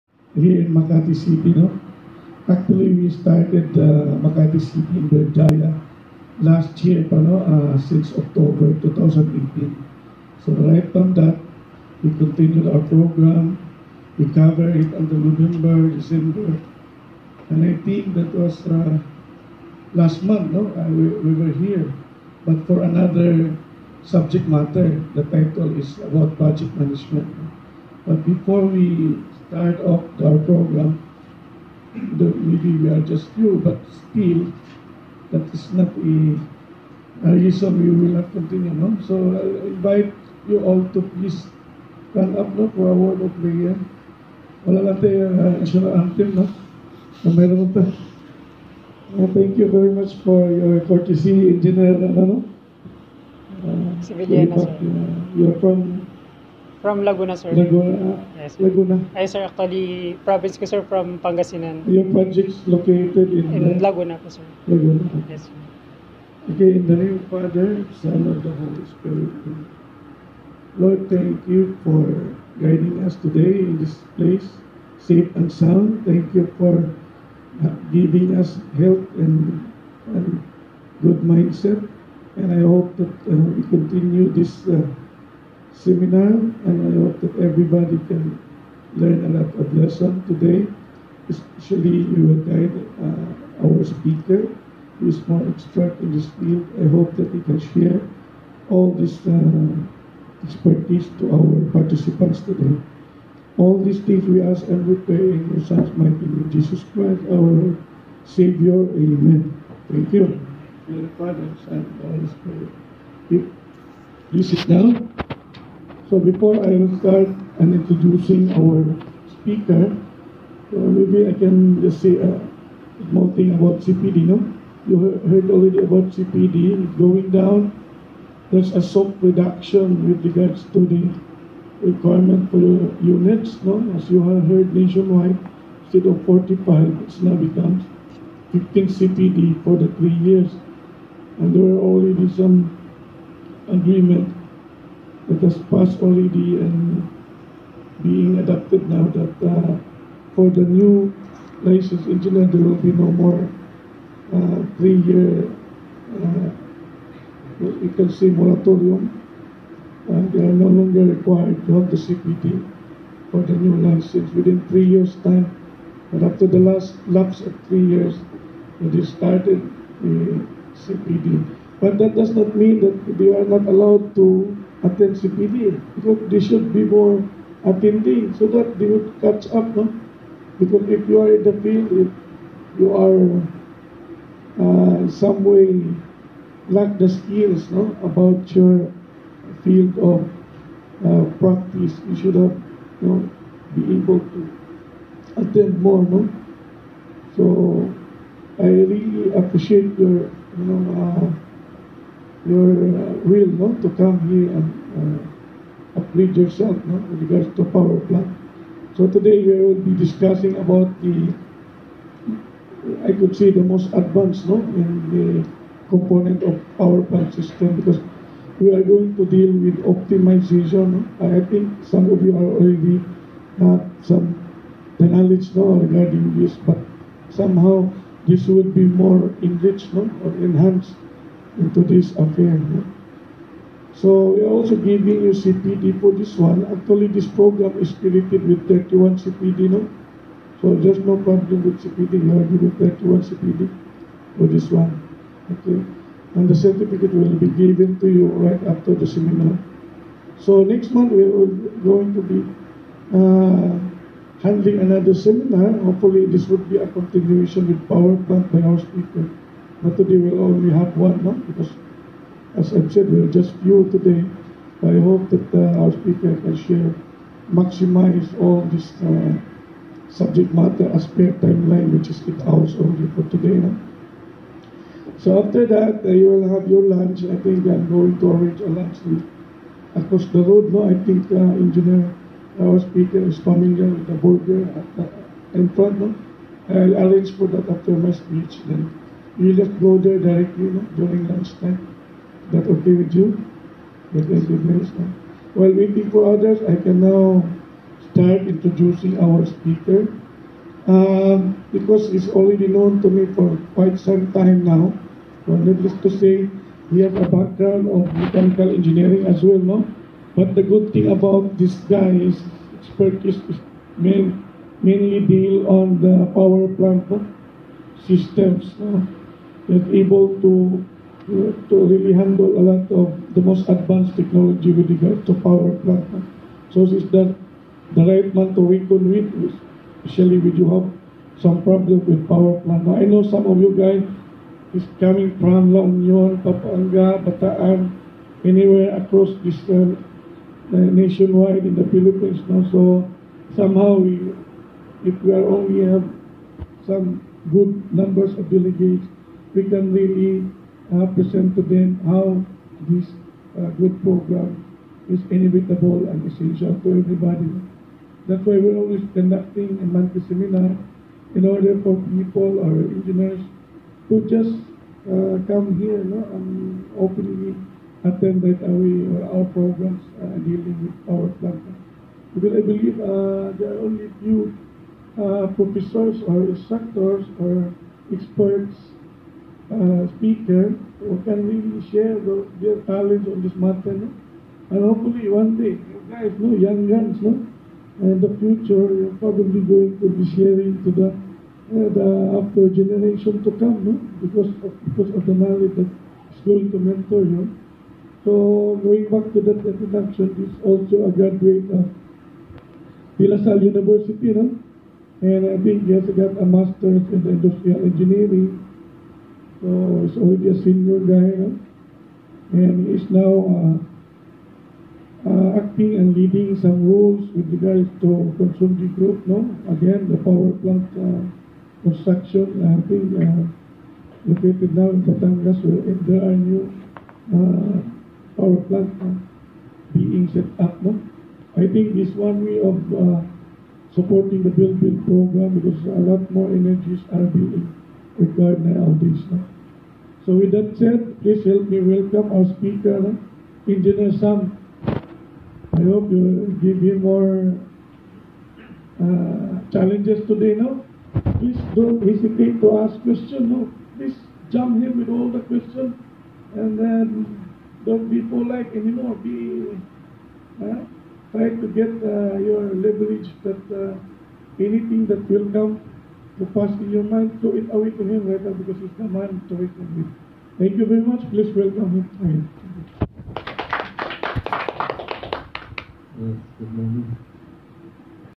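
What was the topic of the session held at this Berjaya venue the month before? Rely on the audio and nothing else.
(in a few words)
budget management.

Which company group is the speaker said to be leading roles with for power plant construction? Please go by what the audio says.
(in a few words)
Consunji Group.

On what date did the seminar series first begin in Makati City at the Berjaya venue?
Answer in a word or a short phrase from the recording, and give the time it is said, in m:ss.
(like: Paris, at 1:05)
6 October 2018, at 0:07.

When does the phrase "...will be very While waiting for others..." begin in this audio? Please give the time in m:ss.
4:54.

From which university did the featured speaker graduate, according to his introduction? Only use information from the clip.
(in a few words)
De La Salle University.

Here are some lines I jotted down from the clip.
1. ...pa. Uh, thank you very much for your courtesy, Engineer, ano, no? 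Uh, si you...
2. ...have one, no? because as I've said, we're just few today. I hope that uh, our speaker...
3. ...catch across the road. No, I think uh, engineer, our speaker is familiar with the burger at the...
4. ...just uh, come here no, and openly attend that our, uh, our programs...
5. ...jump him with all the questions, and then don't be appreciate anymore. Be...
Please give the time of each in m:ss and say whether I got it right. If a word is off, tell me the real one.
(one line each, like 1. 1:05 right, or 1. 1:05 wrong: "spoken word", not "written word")
1. 0:47 right
2. 4:20 right
3. 4:38 wrong: "lunch", not "catch"
4. 6:04 right
5. 7:34 wrong: "polite", not "appreciate".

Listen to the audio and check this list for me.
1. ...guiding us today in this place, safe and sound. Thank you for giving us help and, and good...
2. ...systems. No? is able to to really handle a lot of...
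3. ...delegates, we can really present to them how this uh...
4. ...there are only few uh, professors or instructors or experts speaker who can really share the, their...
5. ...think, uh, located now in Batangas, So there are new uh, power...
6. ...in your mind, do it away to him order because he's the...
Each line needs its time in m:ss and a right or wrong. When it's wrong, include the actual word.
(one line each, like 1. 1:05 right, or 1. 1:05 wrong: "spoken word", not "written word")
1. 1:12 right
2. 5:18 right
3. 5:48 right
4. 6:13 right
5. 7:02 right
6. 7:46 wrong: "rather", not "order".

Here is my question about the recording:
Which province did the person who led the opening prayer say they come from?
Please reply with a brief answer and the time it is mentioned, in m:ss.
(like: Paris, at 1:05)
Pangasinan, at 1:01.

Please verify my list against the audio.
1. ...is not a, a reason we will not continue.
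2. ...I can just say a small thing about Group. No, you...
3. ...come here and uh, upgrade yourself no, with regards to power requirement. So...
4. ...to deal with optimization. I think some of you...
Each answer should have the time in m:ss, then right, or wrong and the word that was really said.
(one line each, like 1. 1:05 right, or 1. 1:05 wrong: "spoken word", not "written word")
1. 0:35 right
2. 2:01 wrong: "CPD", not "Group"
3. 3:23 wrong: "plant", not "requirement"
4. 3:39 right.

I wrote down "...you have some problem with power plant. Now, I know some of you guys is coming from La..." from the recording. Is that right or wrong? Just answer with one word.
right.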